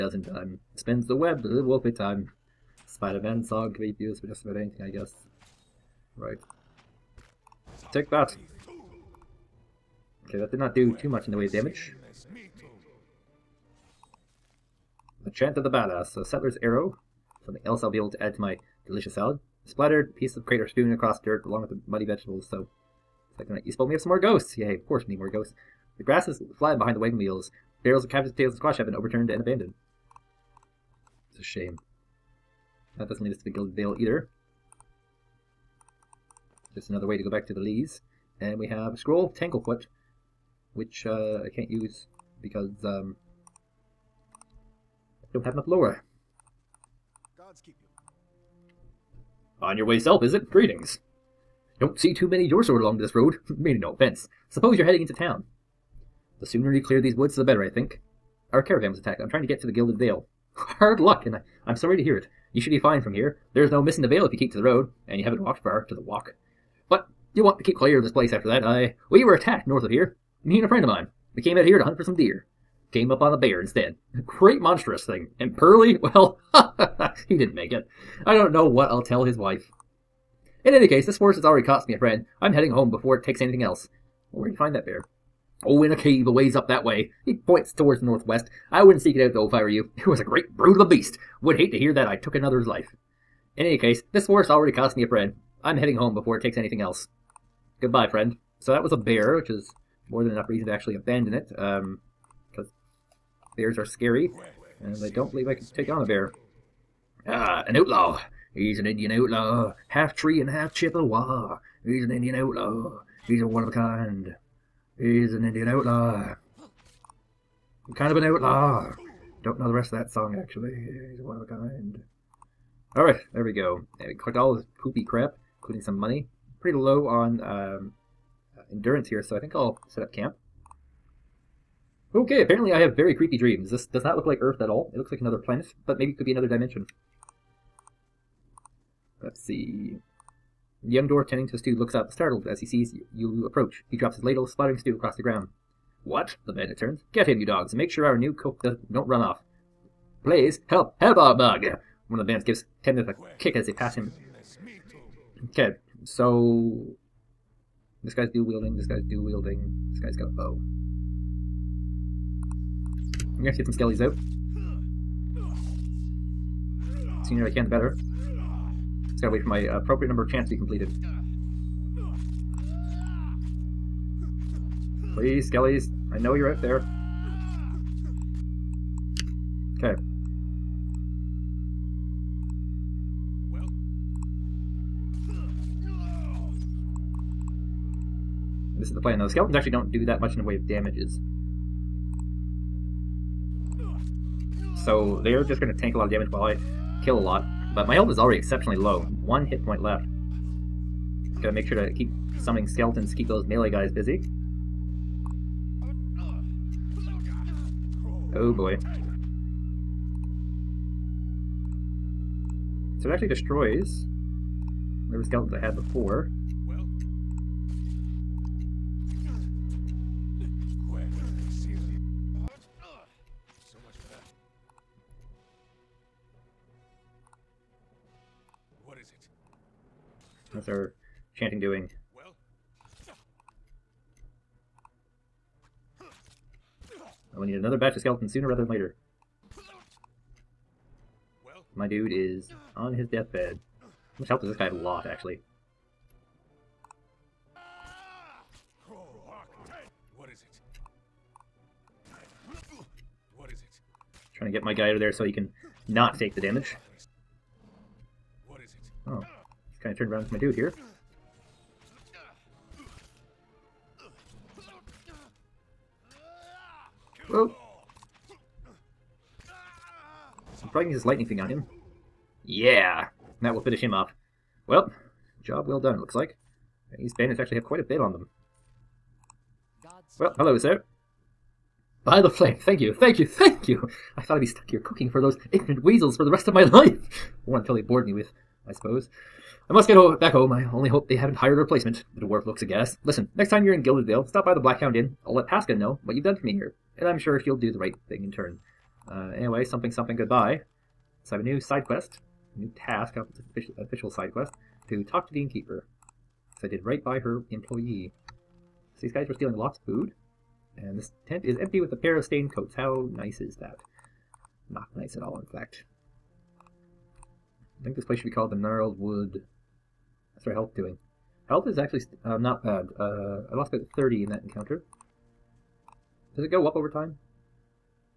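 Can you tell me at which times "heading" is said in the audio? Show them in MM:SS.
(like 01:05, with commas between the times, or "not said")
00:54, 01:22, 01:35.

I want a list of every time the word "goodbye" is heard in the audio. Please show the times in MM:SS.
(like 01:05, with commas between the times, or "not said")
01:37, 05:00.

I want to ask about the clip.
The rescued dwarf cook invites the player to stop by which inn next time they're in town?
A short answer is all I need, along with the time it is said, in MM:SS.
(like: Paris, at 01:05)
Black Hound Inn, at 04:54.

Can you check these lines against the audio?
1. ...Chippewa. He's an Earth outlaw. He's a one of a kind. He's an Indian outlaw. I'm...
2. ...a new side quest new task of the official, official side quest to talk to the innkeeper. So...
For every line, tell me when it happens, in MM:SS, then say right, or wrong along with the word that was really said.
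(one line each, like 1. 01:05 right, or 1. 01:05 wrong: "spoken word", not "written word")
1. 01:50 wrong: "Indian", not "Earth"
2. 05:01 right.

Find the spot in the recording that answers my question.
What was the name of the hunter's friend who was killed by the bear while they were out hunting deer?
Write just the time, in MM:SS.
01:15.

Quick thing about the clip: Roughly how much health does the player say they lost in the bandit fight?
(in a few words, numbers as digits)
30.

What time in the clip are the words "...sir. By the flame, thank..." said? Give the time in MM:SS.
04:40.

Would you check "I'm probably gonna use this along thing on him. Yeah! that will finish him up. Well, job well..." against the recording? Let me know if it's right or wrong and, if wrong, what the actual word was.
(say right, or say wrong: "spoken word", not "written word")
wrong: "lightning", not "along".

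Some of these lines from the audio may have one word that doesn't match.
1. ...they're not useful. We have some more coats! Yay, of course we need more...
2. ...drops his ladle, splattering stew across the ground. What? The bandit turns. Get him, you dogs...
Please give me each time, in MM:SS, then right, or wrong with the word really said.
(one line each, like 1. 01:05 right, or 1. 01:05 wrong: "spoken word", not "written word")
1. 00:23 wrong: "ghosts", not "coats"
2. 02:23 right.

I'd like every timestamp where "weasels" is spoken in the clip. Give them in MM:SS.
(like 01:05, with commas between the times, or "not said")
04:45.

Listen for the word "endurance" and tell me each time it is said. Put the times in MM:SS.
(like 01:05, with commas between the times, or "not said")
02:08.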